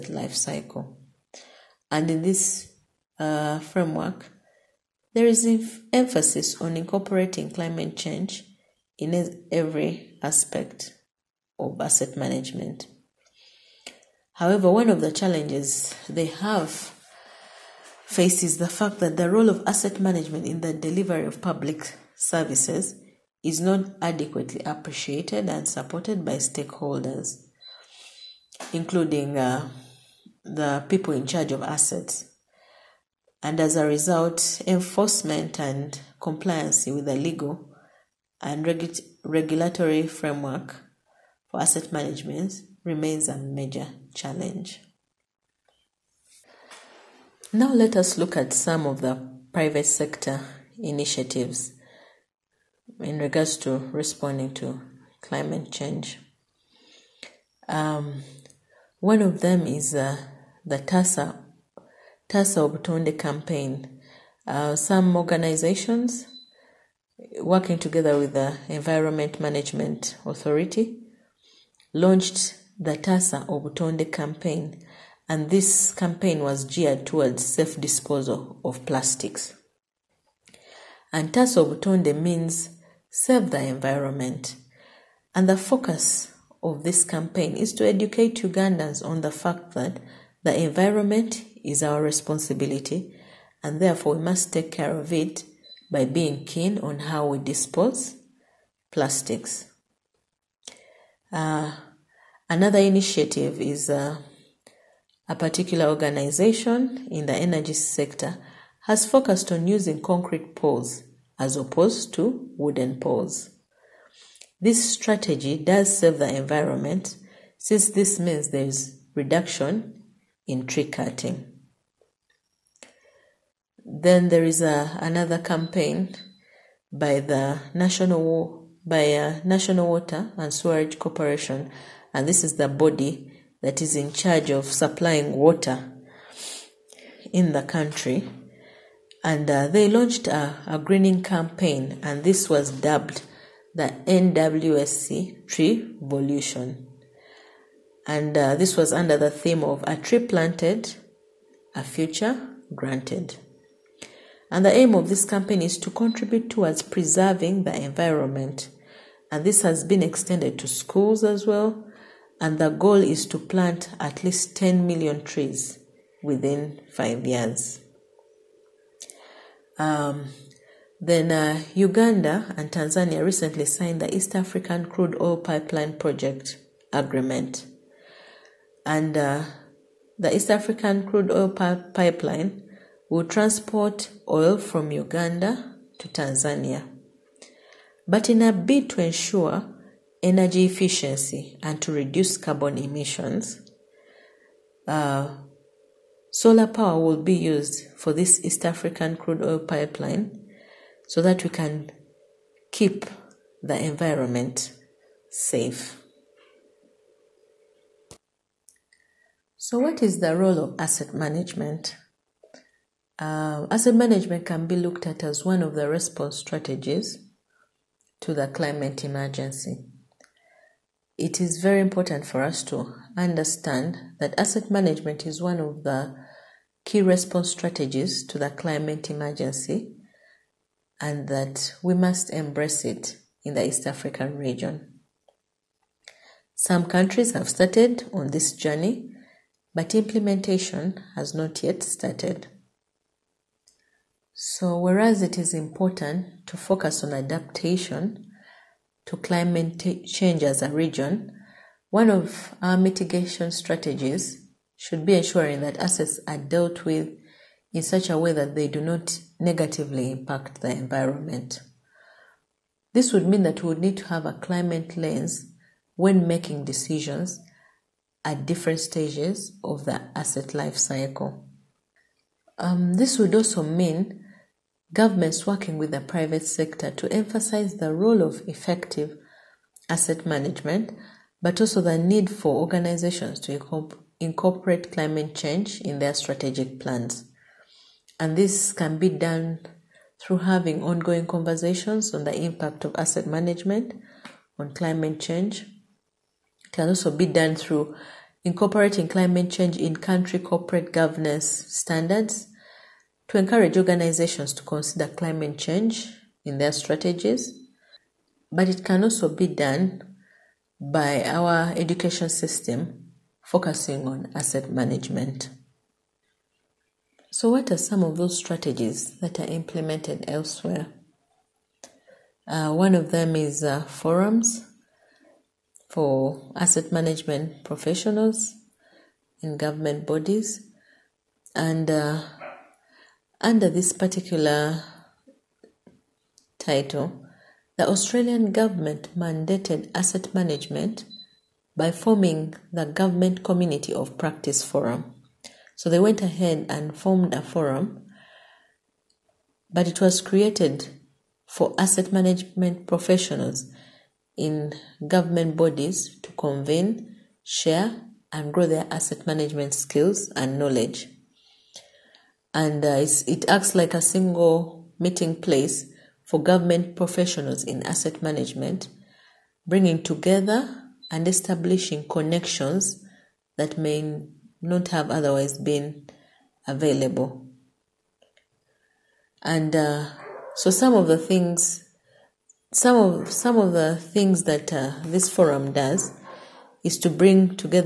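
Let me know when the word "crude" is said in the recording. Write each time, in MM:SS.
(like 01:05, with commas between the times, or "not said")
02:54, 03:01, 03:19.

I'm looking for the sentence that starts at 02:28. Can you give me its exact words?
And uh, this was under the theme of a tree planted, a future granted.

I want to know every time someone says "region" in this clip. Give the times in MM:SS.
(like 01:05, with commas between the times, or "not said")
03:54, 04:10.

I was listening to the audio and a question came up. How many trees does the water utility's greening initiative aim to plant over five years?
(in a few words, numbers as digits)
10 million.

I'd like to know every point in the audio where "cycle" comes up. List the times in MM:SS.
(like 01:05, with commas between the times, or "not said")
00:00, 04:30.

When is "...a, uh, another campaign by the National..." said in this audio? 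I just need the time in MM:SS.
02:04.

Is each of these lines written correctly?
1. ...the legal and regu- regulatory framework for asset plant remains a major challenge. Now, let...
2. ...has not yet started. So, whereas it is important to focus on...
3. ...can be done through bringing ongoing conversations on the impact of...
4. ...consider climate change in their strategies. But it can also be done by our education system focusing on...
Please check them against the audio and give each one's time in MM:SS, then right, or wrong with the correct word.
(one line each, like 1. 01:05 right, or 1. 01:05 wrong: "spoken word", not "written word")
1. 00:37 wrong: "management", not "plant"
2. 04:01 right
3. 04:48 wrong: "having", not "bringing"
4. 05:04 right.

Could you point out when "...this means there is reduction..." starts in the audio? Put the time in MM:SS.
01:57.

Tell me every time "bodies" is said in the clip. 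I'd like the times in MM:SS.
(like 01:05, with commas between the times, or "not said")
05:30, 05:55.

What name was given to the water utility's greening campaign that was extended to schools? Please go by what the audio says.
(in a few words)
NWSC Tree Revolution.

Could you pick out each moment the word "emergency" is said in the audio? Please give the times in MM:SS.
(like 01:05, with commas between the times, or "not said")
03:39, 03:49.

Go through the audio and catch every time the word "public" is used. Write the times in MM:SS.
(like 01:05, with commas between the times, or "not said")
00:21.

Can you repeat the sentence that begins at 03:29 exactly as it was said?
So, what is the role of asset management?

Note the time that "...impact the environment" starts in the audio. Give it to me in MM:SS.
04:20.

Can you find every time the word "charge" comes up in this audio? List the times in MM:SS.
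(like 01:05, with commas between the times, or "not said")
00:31, 02:14.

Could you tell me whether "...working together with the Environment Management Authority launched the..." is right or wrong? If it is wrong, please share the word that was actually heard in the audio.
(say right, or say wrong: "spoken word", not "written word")
right.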